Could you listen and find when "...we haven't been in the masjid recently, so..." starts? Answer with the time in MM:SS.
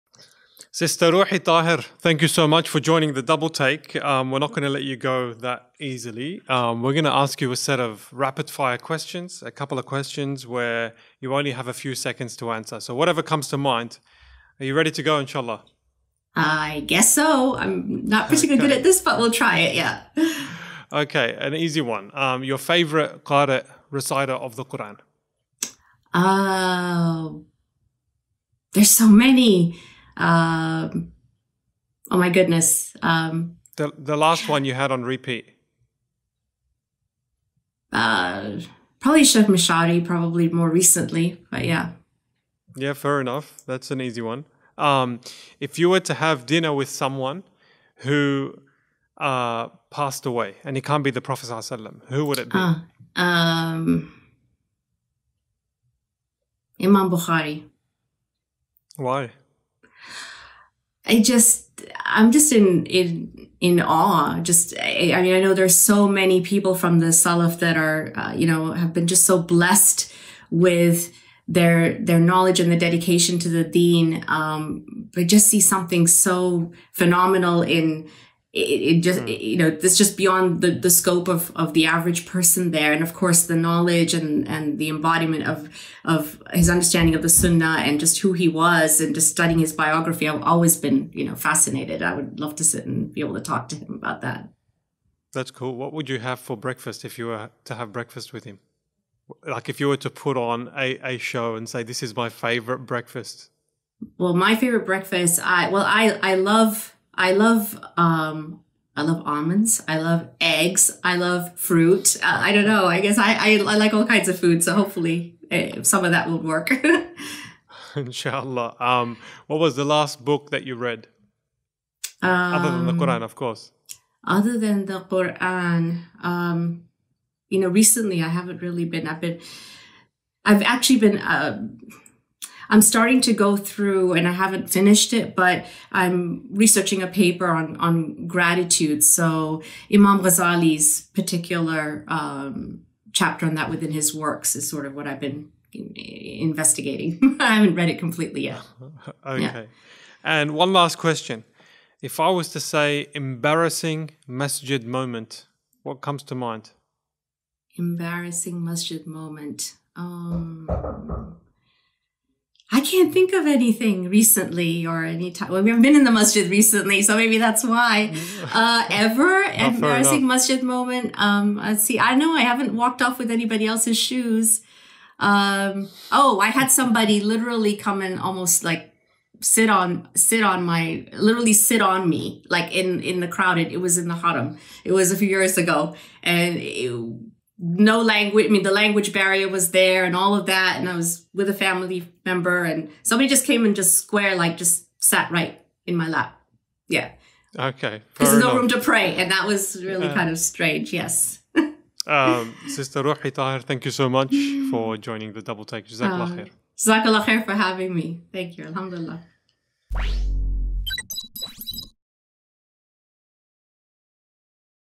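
02:45.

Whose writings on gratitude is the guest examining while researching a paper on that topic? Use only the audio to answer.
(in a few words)
Imam Ghazali.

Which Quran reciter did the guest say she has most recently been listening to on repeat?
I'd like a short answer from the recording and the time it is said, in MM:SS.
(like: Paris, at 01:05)
Sheikh Mashadi, at 00:39.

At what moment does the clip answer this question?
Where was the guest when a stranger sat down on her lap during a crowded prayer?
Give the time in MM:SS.
03:04.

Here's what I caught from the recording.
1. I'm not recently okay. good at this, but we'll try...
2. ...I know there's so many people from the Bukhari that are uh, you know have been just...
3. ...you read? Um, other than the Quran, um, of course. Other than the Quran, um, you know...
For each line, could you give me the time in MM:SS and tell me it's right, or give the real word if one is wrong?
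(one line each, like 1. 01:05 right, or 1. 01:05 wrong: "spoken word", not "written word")
1. 00:17 wrong: "particularly", not "recently"
2. 01:05 wrong: "Salaf", not "Bukhari"
3. 02:00 right.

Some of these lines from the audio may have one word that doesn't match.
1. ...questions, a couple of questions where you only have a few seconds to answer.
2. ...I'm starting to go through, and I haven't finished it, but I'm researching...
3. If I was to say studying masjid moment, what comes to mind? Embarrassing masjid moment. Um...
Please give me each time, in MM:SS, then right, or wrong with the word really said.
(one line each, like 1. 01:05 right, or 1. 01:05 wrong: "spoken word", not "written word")
1. 00:08 right
2. 02:12 right
3. 02:32 wrong: "embarrassing", not "studying".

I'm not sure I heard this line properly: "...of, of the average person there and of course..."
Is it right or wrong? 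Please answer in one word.
right.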